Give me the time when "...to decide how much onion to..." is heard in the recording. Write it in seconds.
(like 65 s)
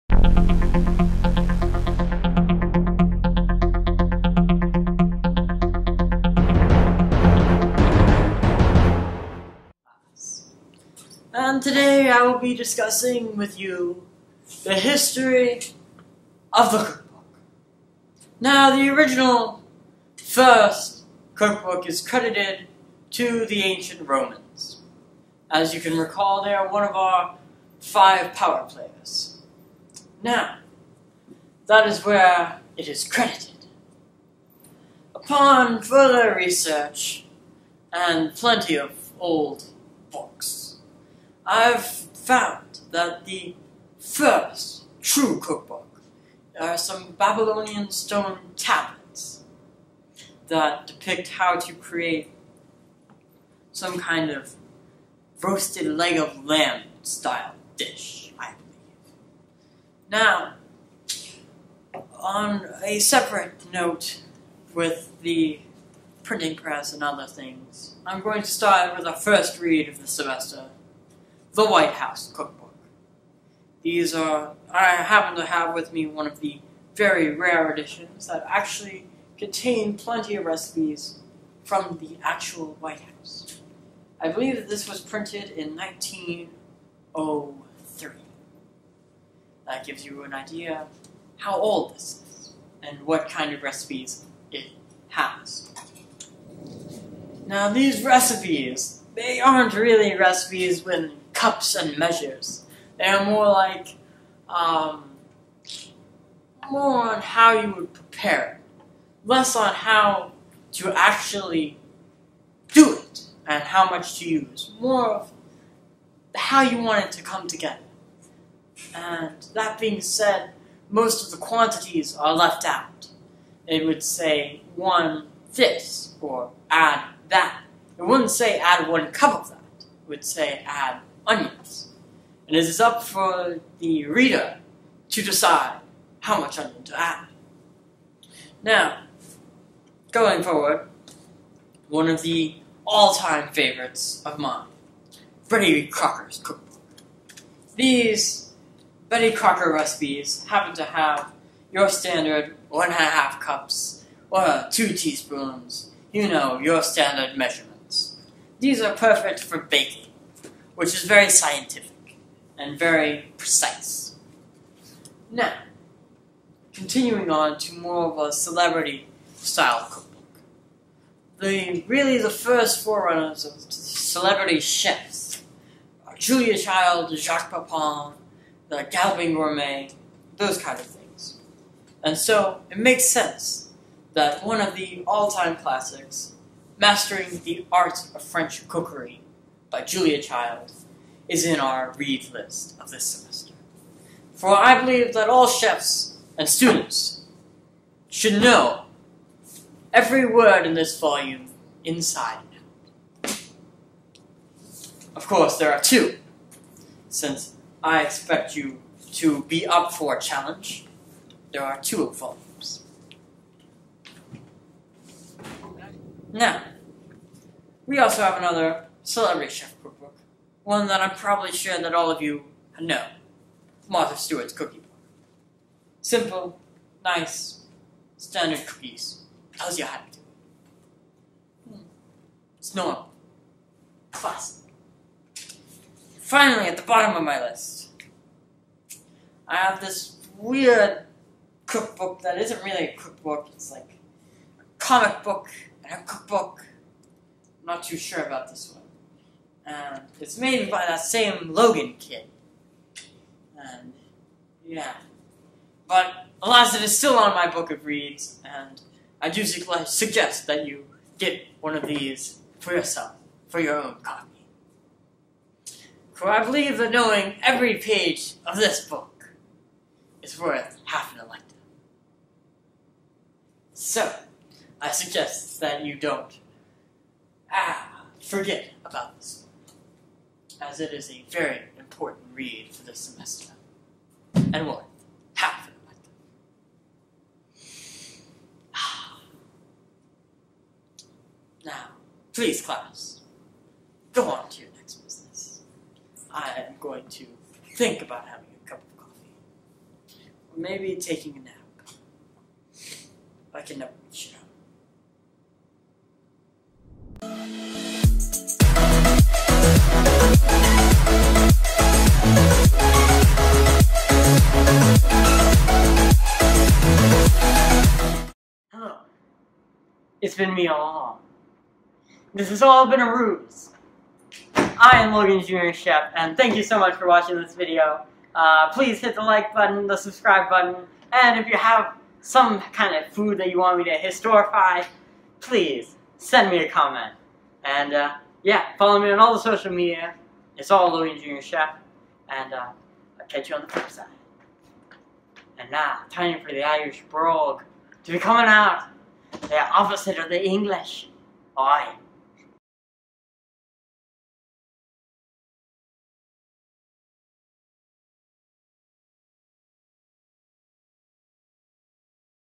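135 s.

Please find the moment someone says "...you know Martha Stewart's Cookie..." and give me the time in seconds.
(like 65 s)
222 s.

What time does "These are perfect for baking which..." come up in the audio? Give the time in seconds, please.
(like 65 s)
158 s.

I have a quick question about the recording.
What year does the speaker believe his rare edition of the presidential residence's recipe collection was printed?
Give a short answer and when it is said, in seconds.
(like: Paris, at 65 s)
1903, at 85 s.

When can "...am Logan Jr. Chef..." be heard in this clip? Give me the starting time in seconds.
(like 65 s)
324 s.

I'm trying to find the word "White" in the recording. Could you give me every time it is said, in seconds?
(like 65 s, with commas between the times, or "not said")
71 s, 82 s.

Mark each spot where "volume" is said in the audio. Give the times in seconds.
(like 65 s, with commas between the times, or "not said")
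200 s, 212 s.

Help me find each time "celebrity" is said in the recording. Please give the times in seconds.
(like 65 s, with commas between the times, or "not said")
168 s, 173 s, 219 s.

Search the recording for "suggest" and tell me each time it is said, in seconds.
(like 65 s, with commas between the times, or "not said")
259 s, 274 s.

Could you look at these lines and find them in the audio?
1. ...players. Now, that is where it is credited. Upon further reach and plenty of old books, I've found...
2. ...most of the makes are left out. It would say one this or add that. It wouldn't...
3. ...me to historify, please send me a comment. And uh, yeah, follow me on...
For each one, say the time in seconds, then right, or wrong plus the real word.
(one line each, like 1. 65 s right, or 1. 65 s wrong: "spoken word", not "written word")
1. 28 s wrong: "research", not "reach"
2. 120 s wrong: "quantities", not "makes"
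3. 333 s right.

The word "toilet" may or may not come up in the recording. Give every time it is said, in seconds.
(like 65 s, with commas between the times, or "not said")
not said.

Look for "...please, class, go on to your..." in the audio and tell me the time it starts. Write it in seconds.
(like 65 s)
292 s.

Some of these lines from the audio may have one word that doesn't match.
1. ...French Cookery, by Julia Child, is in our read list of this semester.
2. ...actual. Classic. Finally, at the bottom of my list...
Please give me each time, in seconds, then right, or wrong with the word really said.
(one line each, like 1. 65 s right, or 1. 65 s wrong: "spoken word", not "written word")
1. 188 s right
2. 232 s wrong: "normal", not "actual".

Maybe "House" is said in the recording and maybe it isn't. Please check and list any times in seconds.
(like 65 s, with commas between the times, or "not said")
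71 s, 83 s.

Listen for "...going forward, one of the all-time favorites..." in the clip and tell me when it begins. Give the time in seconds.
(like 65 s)
140 s.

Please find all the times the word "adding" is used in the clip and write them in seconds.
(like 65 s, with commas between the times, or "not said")
not said.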